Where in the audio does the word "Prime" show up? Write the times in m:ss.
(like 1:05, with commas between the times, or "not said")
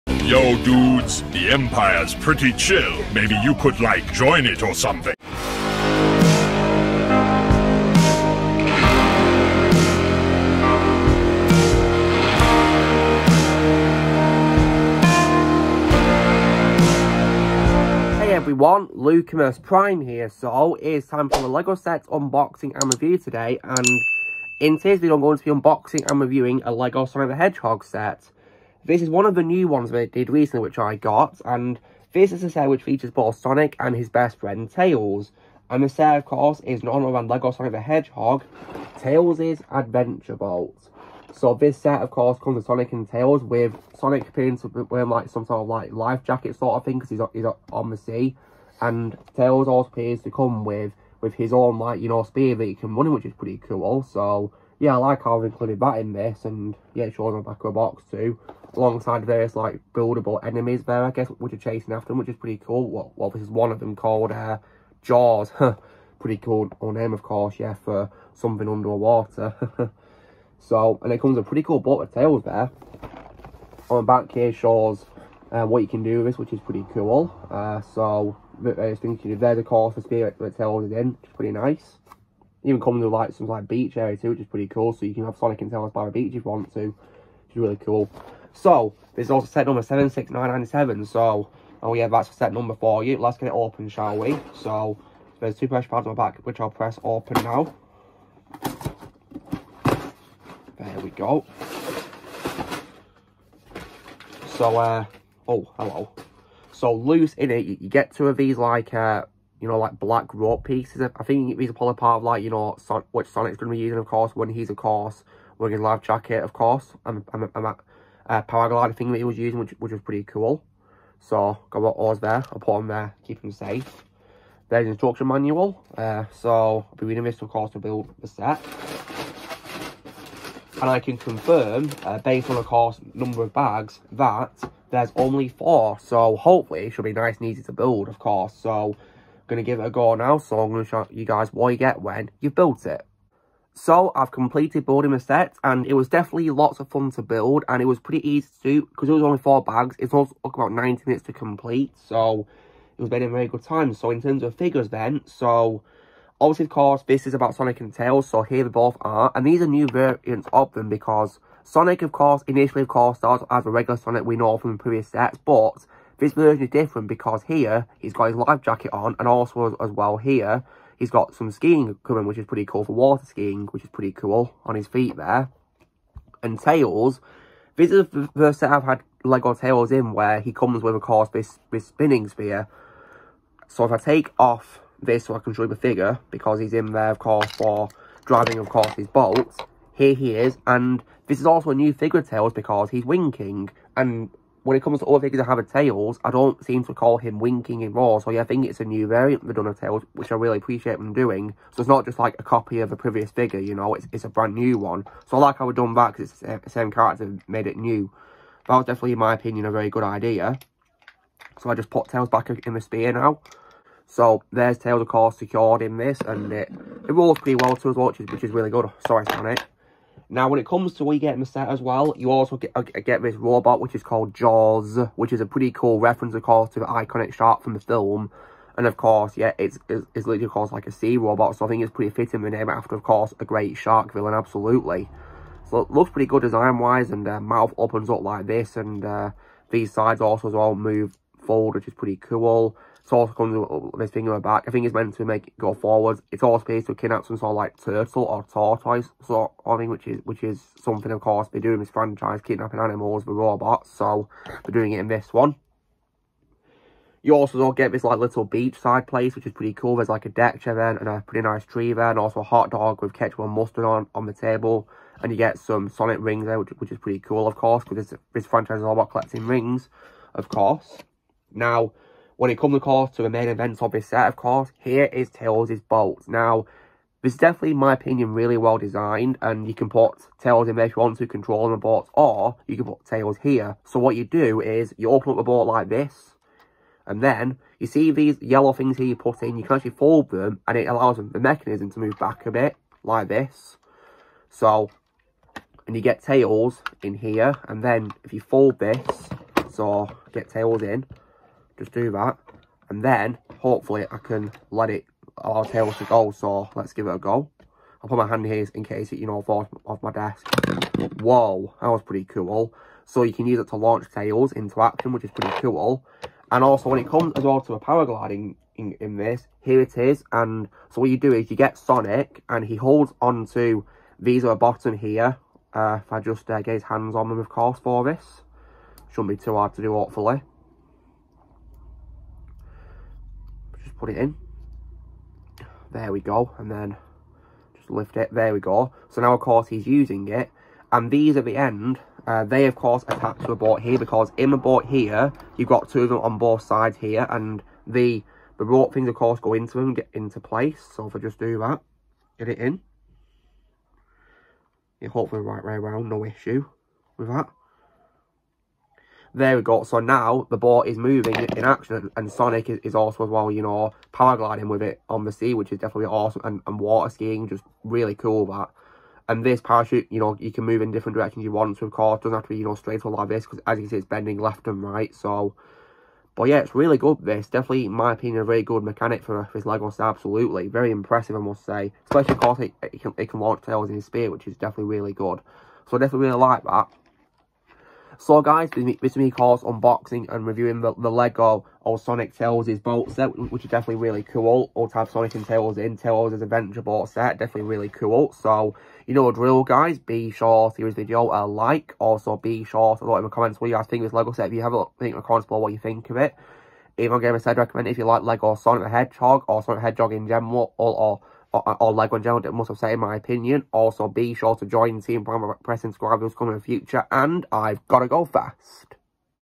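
0:19, 6:55.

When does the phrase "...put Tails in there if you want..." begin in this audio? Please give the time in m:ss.
4:39.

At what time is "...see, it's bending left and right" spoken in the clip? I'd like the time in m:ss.
6:13.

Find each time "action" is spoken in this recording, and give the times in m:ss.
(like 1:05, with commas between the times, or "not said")
5:14, 6:01.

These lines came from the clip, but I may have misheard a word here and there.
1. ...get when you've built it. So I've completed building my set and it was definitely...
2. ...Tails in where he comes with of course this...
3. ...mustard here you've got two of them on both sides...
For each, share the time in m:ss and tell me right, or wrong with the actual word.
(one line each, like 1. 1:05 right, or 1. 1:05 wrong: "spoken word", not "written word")
1. 2:21 right
2. 2:59 right
3. 5:44 wrong: "board", not "mustard".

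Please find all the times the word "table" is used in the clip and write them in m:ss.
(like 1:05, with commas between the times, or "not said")
4:24.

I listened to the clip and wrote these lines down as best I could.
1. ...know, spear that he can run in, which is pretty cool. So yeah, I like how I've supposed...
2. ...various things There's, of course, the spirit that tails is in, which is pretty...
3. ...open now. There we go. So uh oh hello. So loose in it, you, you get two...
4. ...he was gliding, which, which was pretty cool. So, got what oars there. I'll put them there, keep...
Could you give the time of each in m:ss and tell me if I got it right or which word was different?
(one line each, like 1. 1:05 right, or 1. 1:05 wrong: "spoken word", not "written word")
1. 0:52 wrong: "included", not "supposed"
2. 1:18 right
3. 1:37 right
4. 1:59 wrong: "using", not "gliding".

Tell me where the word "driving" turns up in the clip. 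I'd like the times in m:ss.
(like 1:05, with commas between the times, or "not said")
3:08.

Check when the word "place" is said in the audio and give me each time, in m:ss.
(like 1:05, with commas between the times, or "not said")
4:19, 5:50.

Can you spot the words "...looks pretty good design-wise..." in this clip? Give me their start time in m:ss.
3:55.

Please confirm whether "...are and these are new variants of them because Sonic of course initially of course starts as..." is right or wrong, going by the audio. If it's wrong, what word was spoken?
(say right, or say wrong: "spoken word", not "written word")
right.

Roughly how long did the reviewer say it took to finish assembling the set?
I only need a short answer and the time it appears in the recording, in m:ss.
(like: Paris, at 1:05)
90 minutes, at 2:30.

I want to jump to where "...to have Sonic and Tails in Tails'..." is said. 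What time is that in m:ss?
6:34.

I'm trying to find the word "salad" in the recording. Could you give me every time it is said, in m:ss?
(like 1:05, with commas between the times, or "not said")
not said.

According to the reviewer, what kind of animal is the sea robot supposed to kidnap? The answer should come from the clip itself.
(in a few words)
Turtle or tortoise.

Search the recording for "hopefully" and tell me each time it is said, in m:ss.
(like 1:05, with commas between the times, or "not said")
2:16, 5:03, 5:29, 5:55.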